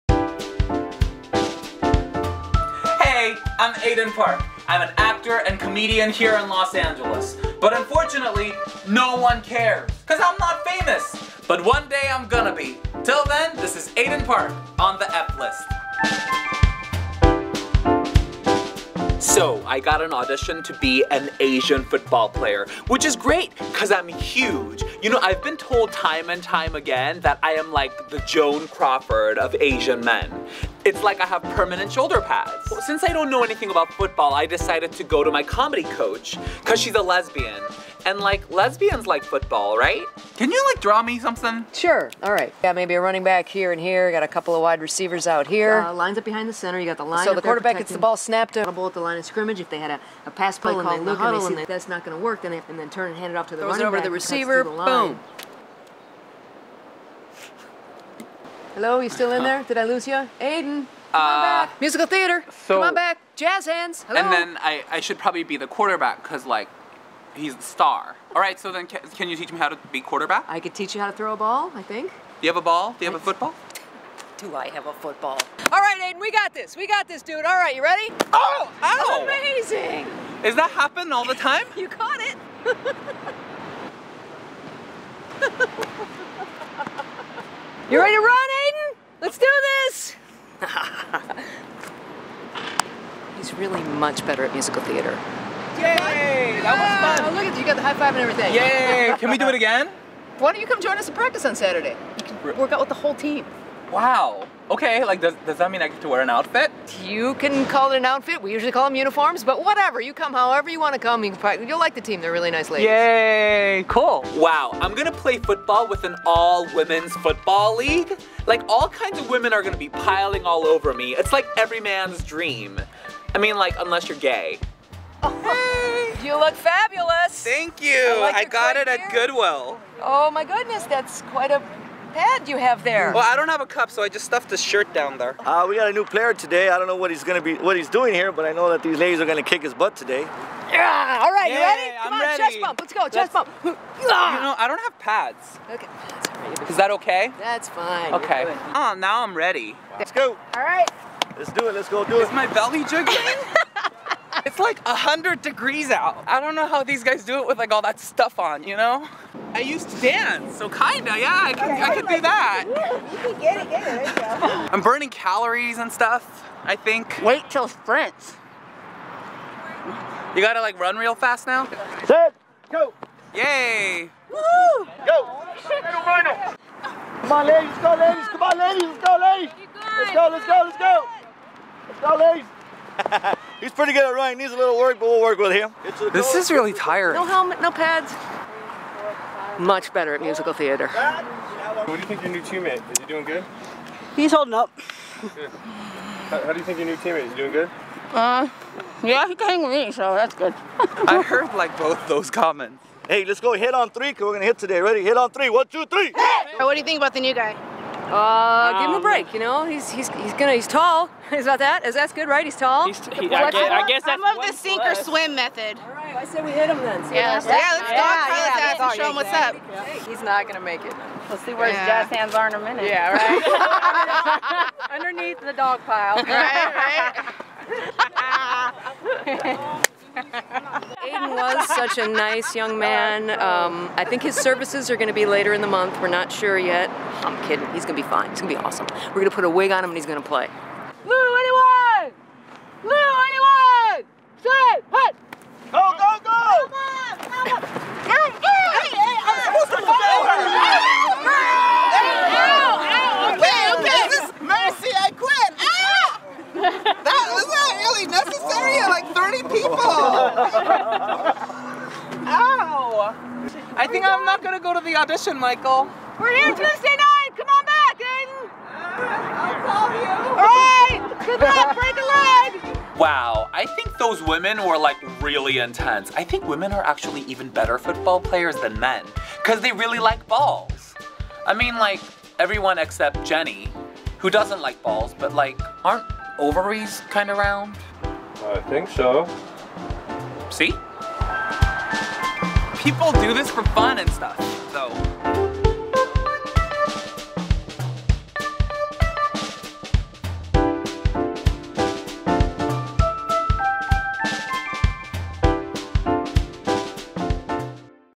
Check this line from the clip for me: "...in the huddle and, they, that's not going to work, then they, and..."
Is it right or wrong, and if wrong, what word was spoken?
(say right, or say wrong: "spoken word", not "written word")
right.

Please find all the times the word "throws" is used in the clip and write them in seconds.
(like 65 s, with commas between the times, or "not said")
53 s, 71 s.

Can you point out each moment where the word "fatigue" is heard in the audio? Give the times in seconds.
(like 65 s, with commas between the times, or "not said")
not said.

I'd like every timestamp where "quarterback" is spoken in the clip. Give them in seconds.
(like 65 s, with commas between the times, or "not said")
47 s, 65 s, 70 s.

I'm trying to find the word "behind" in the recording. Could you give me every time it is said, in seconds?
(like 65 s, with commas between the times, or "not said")
46 s.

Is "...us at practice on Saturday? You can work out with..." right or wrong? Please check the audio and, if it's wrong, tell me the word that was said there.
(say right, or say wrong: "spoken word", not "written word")
right.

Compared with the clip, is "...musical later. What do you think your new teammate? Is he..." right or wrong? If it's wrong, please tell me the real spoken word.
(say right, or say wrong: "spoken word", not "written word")
wrong: "theater", not "later".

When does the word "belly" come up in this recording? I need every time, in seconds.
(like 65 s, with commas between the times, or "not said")
152 s.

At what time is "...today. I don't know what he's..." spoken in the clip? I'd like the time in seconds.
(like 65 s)
136 s.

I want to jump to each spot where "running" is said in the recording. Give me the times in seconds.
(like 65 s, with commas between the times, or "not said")
43 s, 53 s, 184 s.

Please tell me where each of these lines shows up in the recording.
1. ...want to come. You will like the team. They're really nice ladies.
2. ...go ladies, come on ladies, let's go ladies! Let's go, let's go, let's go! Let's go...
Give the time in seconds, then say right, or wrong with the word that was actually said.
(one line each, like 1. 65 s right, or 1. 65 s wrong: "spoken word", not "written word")
1. 110 s right
2. 177 s right.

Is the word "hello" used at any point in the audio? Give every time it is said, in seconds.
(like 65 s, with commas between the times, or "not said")
58 s, 64 s.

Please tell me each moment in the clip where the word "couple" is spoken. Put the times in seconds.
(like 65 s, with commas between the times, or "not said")
44 s.